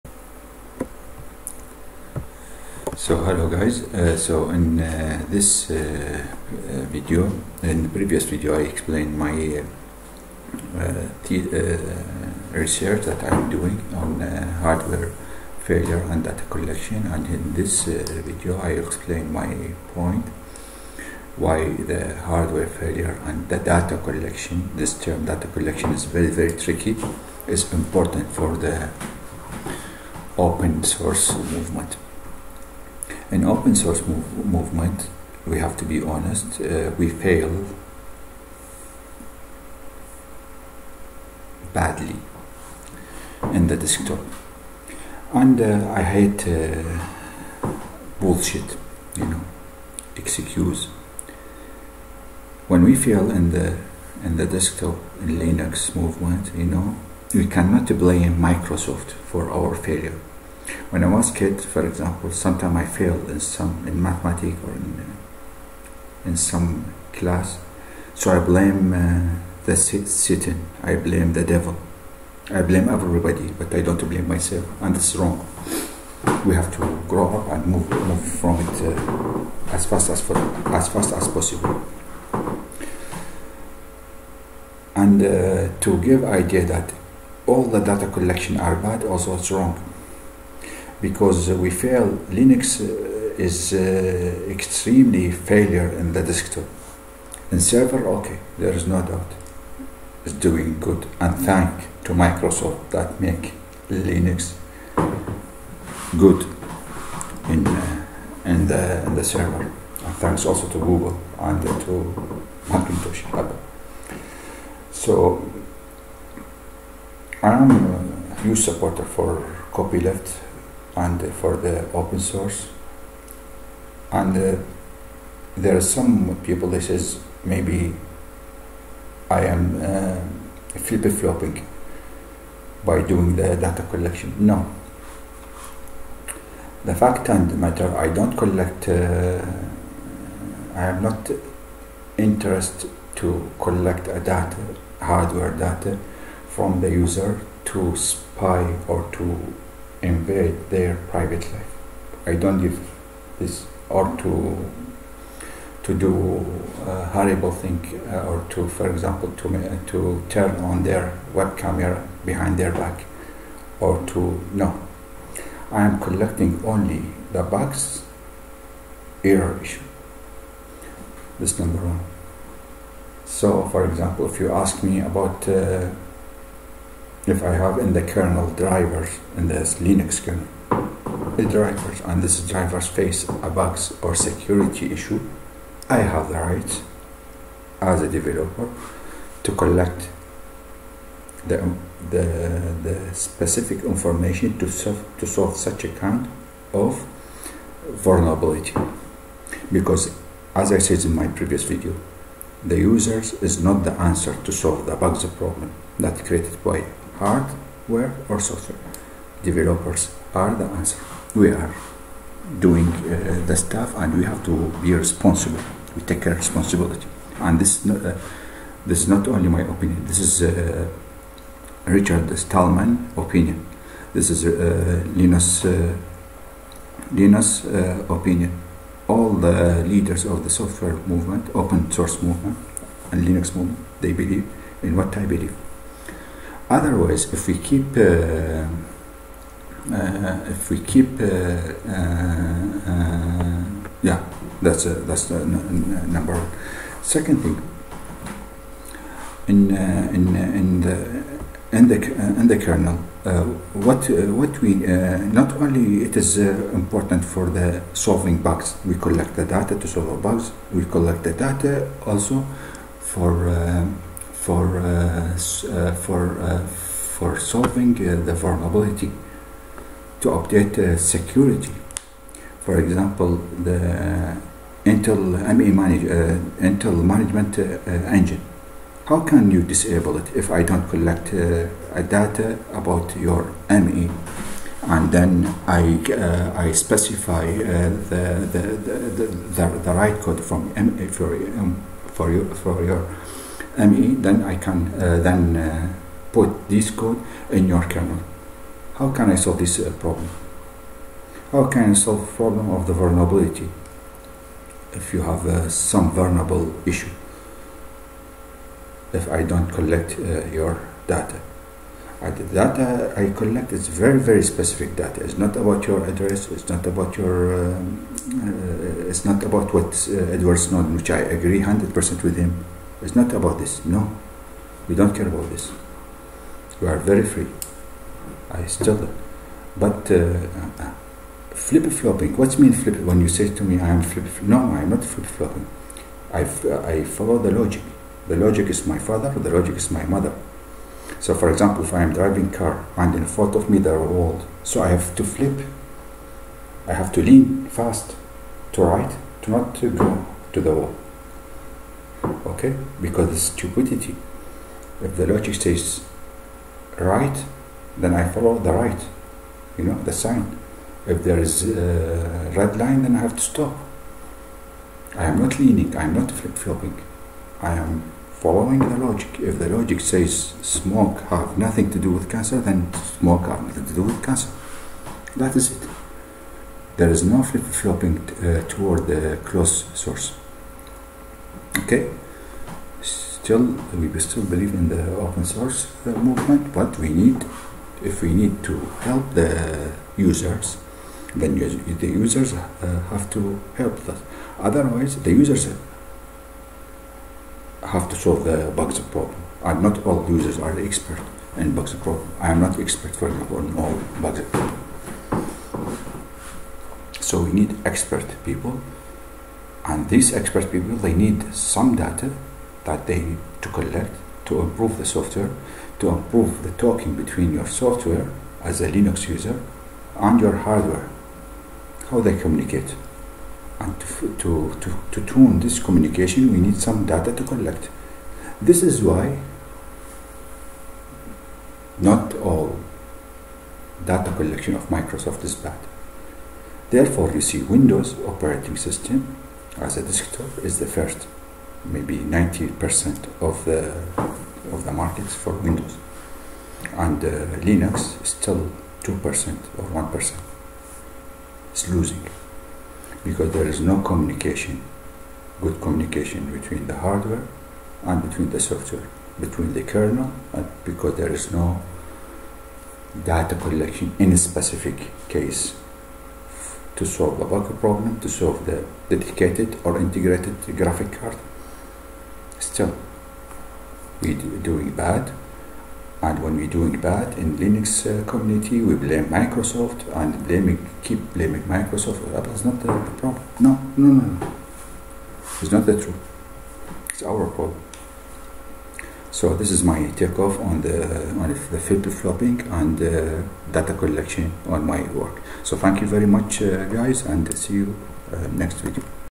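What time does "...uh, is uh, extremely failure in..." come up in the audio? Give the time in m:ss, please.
1:32.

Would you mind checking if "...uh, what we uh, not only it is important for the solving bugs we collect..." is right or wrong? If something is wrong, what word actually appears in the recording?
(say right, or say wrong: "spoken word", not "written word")
right.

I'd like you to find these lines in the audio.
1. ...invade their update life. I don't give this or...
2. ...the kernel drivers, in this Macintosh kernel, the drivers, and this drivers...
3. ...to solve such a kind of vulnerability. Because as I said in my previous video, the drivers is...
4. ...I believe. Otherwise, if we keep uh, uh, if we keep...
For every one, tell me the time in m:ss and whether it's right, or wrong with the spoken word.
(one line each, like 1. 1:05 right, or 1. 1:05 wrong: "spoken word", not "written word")
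1. 2:30 wrong: "private", not "update"
2. 2:57 wrong: "Linux", not "Macintosh"
3. 3:15 wrong: "users", not "drivers"
4. 3:55 right.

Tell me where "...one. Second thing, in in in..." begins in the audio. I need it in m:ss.
4:06.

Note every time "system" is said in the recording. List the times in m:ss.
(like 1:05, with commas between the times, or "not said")
7:18.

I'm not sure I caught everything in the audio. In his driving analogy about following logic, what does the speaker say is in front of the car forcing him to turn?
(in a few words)
Walls.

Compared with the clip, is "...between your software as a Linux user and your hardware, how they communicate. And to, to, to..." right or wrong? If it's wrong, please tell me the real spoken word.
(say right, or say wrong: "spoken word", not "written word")
right.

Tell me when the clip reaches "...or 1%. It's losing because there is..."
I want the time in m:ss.
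7:29.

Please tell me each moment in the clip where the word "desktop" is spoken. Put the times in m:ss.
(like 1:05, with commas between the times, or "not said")
0:43, 0:54, 1:36, 7:20.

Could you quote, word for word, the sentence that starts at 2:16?
The fact and matter, I don't collect.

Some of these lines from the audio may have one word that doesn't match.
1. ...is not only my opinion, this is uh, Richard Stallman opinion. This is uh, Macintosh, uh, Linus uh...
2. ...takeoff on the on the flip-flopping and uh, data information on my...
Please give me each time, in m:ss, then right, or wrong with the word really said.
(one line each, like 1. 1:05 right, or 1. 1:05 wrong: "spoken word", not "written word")
1. 3:39 wrong: "Linus", not "Macintosh"
2. 8:10 wrong: "collection", not "information".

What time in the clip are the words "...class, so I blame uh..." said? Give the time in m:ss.
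1:07.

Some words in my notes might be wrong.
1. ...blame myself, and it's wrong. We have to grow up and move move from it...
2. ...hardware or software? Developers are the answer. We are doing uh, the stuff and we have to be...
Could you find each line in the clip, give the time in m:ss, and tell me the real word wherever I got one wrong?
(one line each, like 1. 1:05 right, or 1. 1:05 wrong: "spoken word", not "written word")
1. 1:14 right
2. 3:27 right.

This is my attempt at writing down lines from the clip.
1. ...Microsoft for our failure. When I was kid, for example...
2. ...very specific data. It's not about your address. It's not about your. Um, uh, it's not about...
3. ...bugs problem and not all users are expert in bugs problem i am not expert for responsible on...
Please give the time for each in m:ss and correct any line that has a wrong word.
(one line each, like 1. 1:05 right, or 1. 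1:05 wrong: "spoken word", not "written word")
1. 0:58 right
2. 5:14 right
3. 6:38 wrong: "example", not "responsible".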